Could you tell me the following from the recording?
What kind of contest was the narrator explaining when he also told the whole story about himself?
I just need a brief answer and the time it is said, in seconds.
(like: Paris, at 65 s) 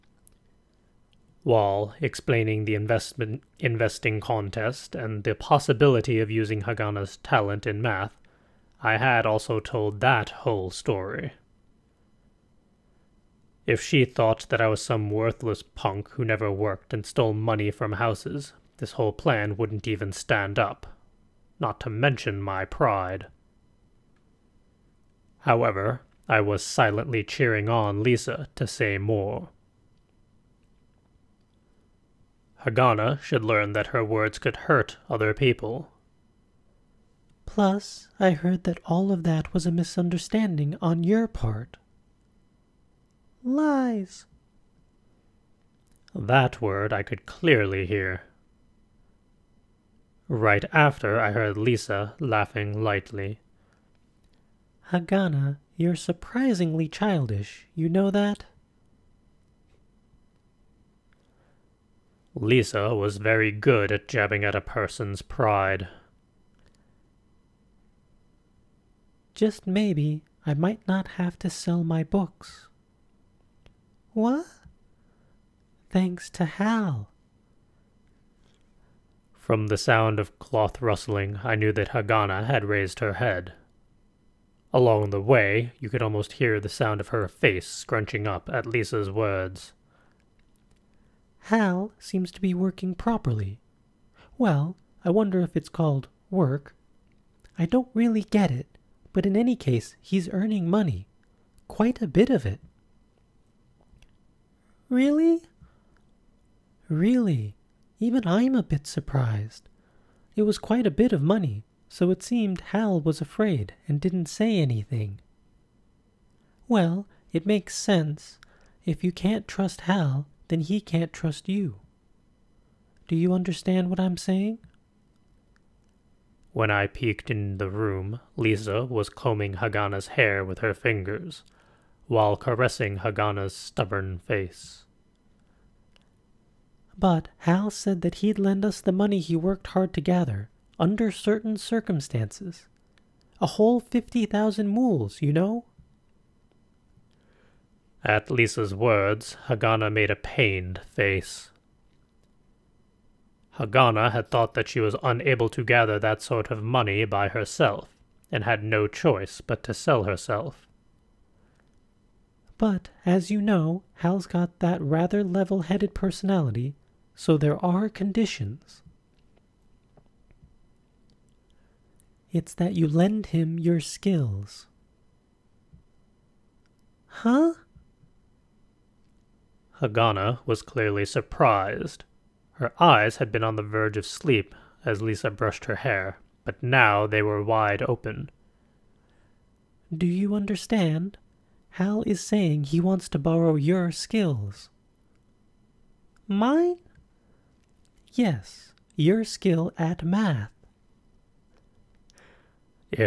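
Investing contest, at 3 s.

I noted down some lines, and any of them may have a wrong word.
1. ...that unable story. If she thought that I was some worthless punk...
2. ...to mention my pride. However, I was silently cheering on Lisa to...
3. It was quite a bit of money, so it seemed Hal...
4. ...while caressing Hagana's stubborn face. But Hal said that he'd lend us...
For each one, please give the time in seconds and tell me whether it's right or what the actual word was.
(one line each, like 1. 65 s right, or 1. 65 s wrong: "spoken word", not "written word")
1. 10 s wrong: "whole", not "unable"
2. 21 s right
3. 110 s right
4. 132 s right.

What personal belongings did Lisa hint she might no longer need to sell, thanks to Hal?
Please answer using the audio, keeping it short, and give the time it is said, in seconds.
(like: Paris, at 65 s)
Books, at 72 s.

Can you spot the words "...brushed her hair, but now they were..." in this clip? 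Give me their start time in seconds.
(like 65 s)
185 s.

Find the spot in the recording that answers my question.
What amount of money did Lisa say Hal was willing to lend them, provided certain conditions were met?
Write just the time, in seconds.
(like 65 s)
143 s.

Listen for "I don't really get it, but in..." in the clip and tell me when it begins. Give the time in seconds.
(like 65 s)
97 s.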